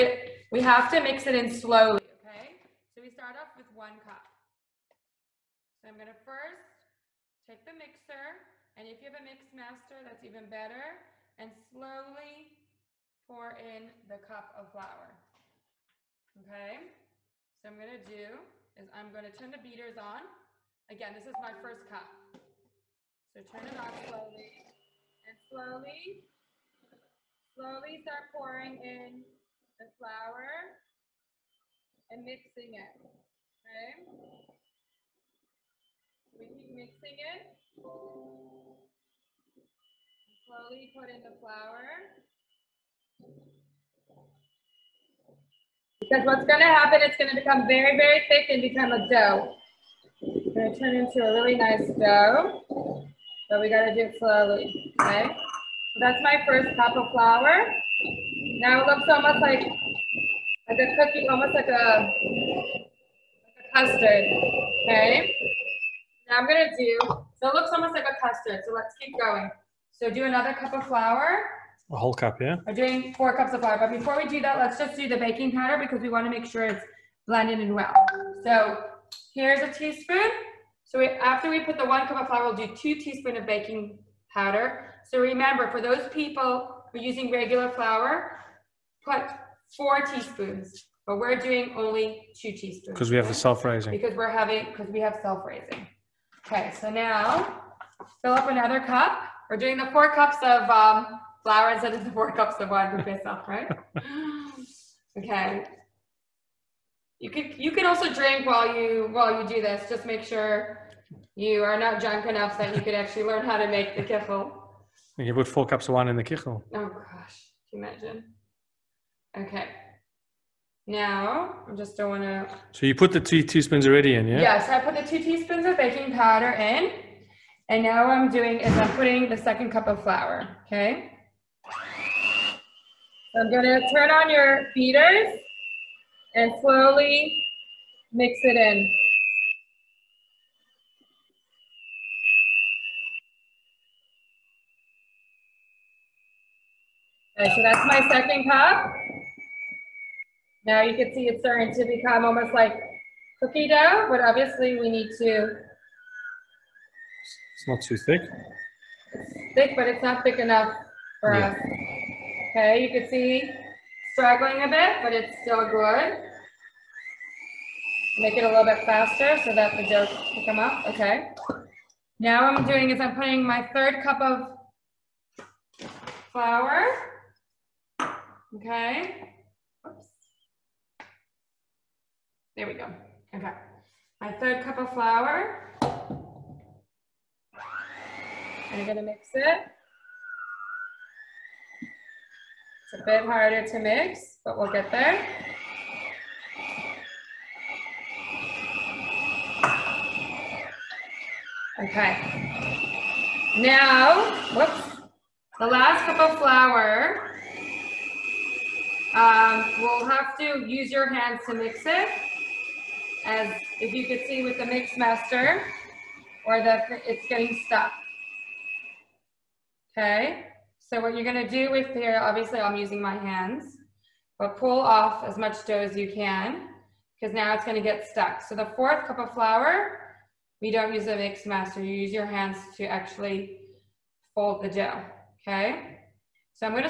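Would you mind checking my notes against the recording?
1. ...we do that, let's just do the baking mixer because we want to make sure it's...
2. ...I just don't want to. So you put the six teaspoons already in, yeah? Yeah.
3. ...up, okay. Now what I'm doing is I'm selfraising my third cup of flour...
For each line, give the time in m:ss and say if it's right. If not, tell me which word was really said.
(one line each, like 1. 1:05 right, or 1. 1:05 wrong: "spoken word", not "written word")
1. 1:14 wrong: "powder", not "mixer"
2. 2:01 wrong: "two", not "six"
3. 2:50 wrong: "putting", not "selfraising".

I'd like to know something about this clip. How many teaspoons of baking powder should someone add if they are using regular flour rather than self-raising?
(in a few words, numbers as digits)
4.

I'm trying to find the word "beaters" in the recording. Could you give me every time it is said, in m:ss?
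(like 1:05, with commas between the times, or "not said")
0:19, 2:14.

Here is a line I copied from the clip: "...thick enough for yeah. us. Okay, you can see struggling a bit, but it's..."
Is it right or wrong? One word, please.
right.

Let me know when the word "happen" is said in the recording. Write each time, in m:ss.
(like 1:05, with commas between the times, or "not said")
0:46.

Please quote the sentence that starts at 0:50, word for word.
It's gonna turn into a really nice dough, but we gotta do it slowly, okay?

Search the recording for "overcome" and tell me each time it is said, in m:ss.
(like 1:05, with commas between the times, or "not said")
not said.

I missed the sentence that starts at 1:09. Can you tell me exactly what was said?
So do another cup of flour.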